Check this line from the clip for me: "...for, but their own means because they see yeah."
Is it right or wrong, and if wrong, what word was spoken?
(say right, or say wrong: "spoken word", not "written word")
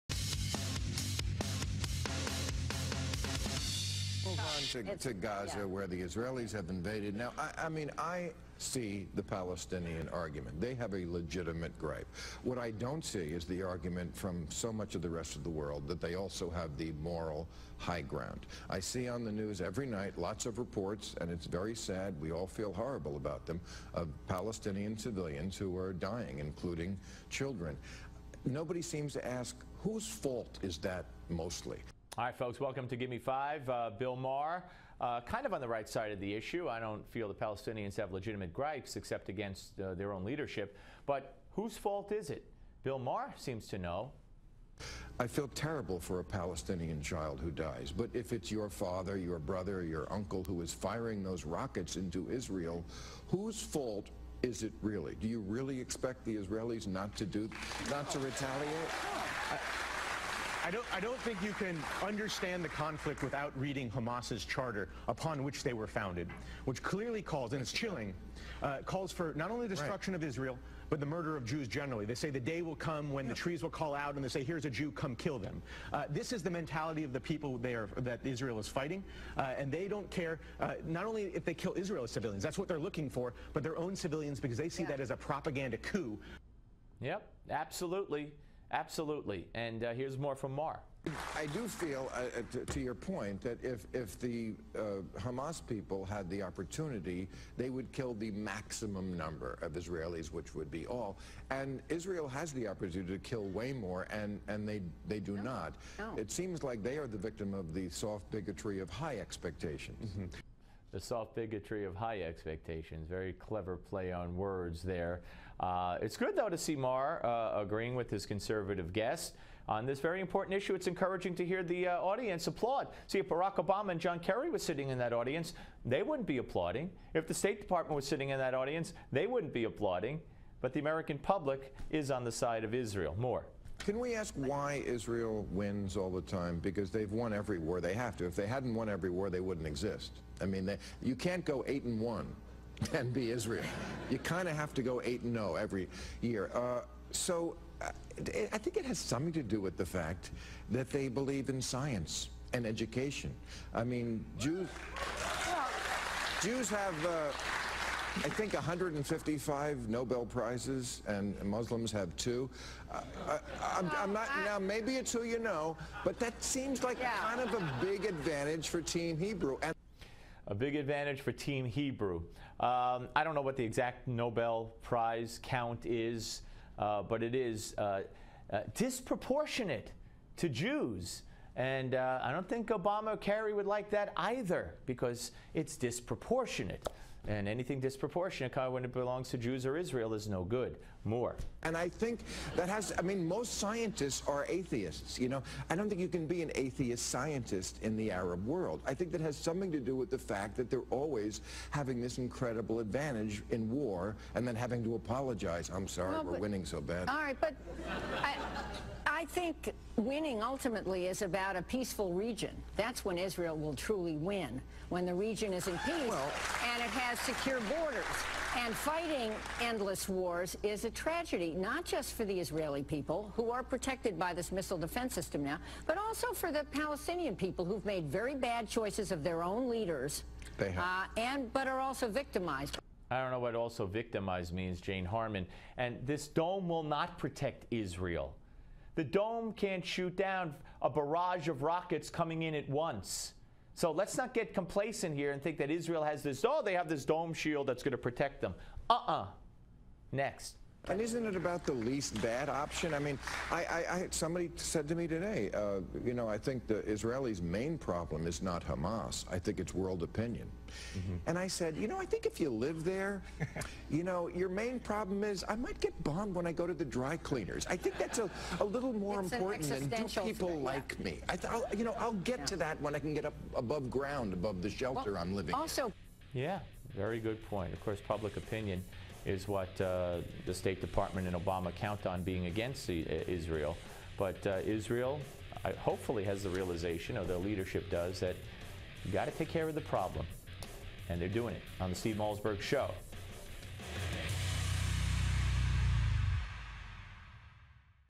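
wrong: "civilians", not "means".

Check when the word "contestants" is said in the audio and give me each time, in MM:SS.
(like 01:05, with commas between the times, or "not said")
not said.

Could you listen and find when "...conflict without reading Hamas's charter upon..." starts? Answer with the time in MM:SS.
01:02.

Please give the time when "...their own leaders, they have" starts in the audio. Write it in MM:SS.
03:49.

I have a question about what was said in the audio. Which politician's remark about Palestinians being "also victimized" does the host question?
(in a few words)
Jane Harman.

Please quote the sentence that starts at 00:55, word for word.
Do you really expect the Israelis not to do, not to retaliate?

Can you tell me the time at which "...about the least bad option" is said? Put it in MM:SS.
04:11.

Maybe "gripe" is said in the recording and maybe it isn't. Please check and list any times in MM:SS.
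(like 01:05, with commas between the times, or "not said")
00:11, 00:38.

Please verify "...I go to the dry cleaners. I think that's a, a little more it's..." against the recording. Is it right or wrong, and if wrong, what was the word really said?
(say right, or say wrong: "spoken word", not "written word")
right.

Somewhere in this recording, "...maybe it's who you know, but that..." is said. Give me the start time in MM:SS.
02:44.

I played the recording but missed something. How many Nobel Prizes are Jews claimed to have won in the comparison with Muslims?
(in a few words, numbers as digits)
155.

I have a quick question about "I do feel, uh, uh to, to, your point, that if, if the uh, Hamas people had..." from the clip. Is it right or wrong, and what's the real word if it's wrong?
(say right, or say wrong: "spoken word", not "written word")
right.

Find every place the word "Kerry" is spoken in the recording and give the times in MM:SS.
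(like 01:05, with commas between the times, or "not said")
02:04, 03:03.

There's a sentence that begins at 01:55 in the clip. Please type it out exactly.
Uh, it's good, though, to see Maher uh, agreeing with his conservative guest on this very important issue.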